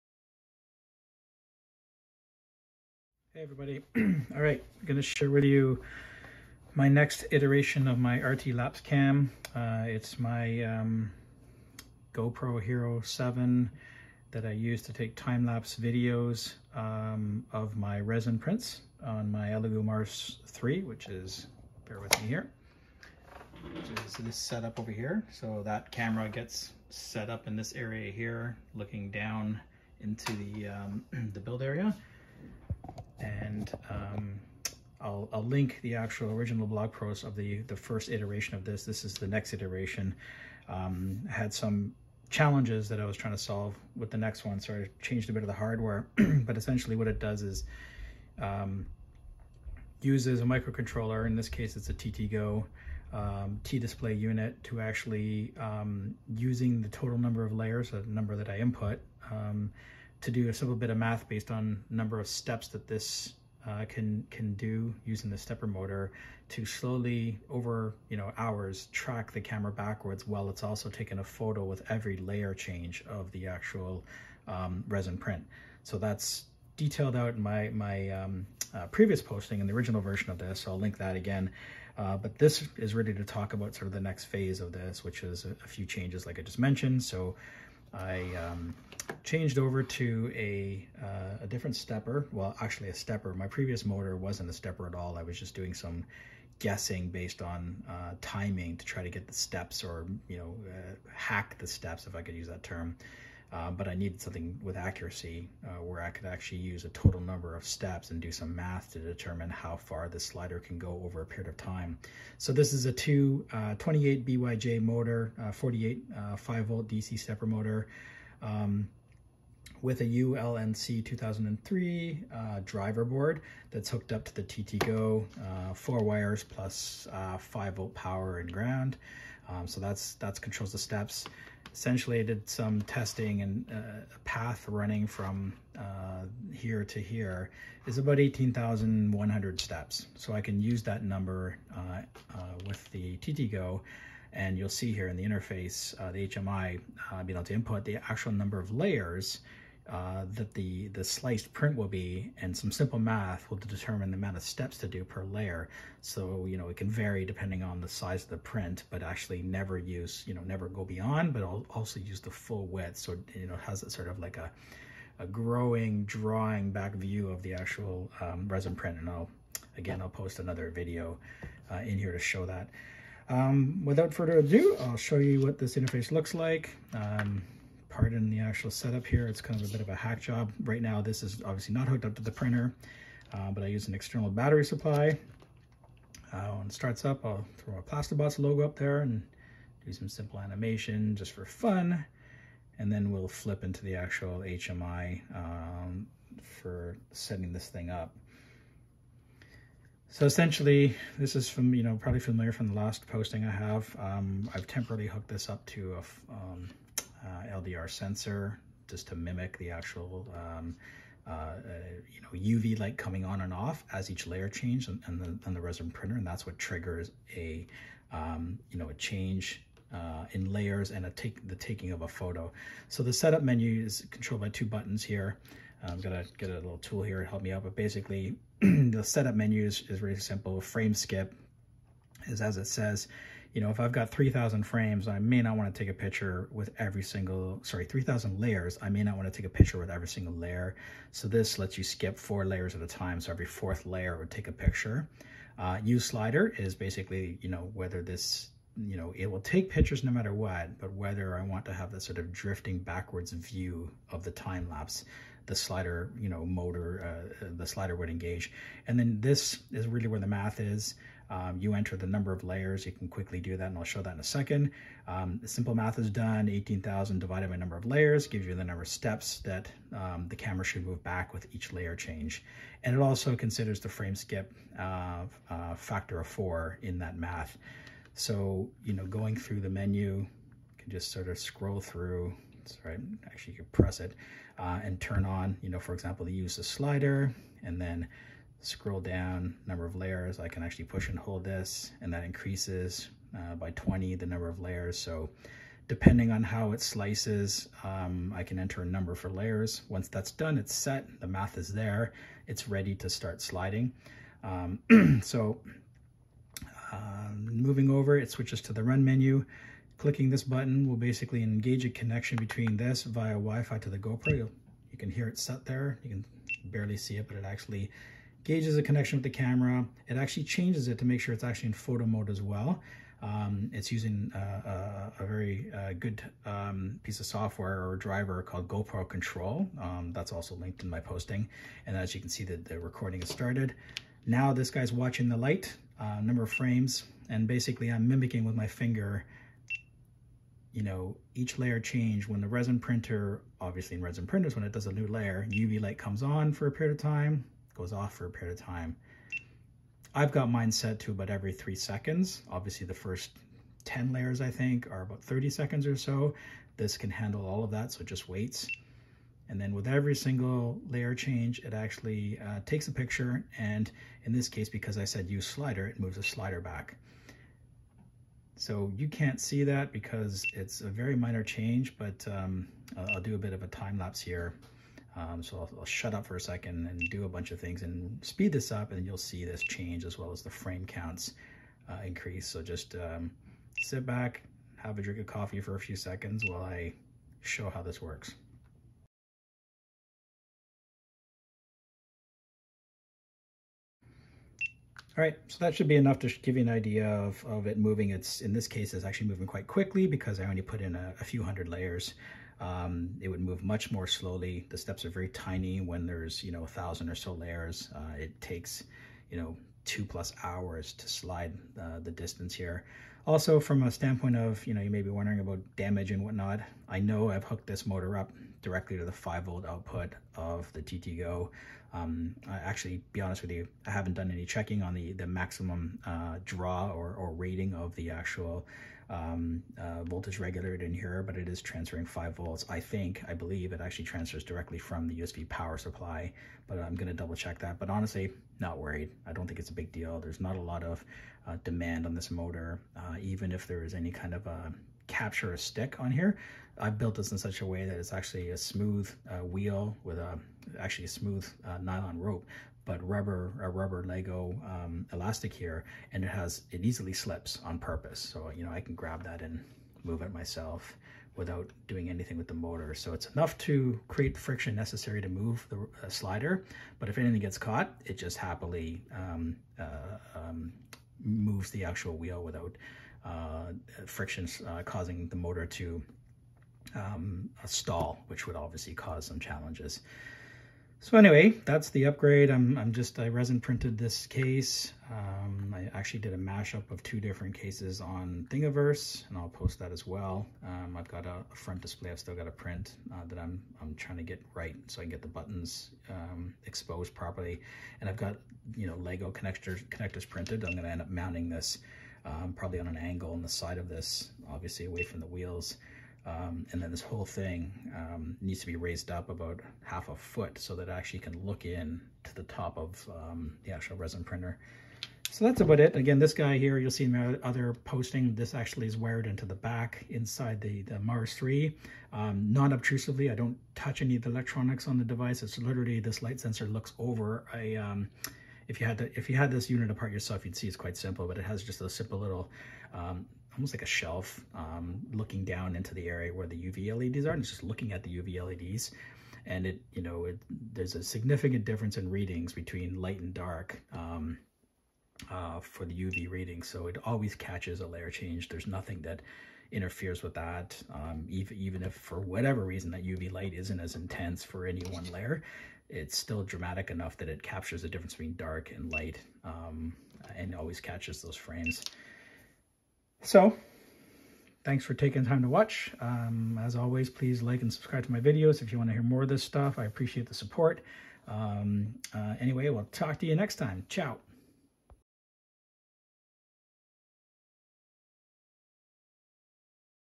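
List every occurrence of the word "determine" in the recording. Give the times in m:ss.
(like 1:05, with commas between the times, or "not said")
1:48, 2:33.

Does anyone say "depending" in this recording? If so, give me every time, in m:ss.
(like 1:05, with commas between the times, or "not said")
2:37, 4:55.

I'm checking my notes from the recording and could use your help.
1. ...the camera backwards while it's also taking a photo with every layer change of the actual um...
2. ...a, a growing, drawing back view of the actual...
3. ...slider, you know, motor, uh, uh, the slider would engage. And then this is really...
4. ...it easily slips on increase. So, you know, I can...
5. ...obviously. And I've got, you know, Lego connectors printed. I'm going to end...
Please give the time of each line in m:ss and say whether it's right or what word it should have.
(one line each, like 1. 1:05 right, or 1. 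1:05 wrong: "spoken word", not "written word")
1. 1:09 right
2. 2:44 right
3. 4:15 right
4. 7:36 wrong: "purpose", not "increase"
5. 8:17 wrong: "properly", not "obviously".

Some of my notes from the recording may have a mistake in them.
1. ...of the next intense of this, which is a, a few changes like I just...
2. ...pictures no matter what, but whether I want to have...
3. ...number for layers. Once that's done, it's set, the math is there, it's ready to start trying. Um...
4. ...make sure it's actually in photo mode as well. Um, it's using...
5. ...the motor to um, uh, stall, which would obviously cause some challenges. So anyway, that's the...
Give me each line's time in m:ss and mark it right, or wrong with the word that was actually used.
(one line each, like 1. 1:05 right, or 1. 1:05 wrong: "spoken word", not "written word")
1. 1:23 wrong: "phase", not "intense"
2. 4:09 right
3. 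4:58 wrong: "sliding", not "trying"
4. 5:21 right
5. 7:55 right.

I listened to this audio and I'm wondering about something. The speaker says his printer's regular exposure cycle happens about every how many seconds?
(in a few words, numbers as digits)
3 seconds.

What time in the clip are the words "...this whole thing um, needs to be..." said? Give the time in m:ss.
8:26.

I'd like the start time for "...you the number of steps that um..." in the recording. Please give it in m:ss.
4:28.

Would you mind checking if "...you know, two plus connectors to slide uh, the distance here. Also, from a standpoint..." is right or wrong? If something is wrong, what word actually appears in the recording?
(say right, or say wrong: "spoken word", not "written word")
wrong: "hours", not "connectors".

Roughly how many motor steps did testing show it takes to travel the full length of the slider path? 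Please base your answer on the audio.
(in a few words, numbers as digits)
18,100.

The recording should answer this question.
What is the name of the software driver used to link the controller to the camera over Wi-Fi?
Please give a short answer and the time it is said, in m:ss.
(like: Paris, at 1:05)
GoPro Control, at 5:28.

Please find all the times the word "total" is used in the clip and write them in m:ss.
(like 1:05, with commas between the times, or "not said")
0:56, 1:46.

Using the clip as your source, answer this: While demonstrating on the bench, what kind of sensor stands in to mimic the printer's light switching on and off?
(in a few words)
LDR sensor.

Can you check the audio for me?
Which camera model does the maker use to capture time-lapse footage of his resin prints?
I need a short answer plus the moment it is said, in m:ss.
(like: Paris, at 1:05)
GoPro Hero 7, at 0:12.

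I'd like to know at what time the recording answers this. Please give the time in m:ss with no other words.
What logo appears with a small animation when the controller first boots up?
3:07.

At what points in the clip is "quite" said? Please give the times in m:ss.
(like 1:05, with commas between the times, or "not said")
6:39, 8:50.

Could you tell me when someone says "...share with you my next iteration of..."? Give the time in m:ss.
0:05.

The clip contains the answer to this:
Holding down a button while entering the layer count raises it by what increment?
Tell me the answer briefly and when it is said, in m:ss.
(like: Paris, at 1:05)
20, at 4:53.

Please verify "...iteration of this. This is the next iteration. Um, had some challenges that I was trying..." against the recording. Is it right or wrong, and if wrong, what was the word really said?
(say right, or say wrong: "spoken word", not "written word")
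right.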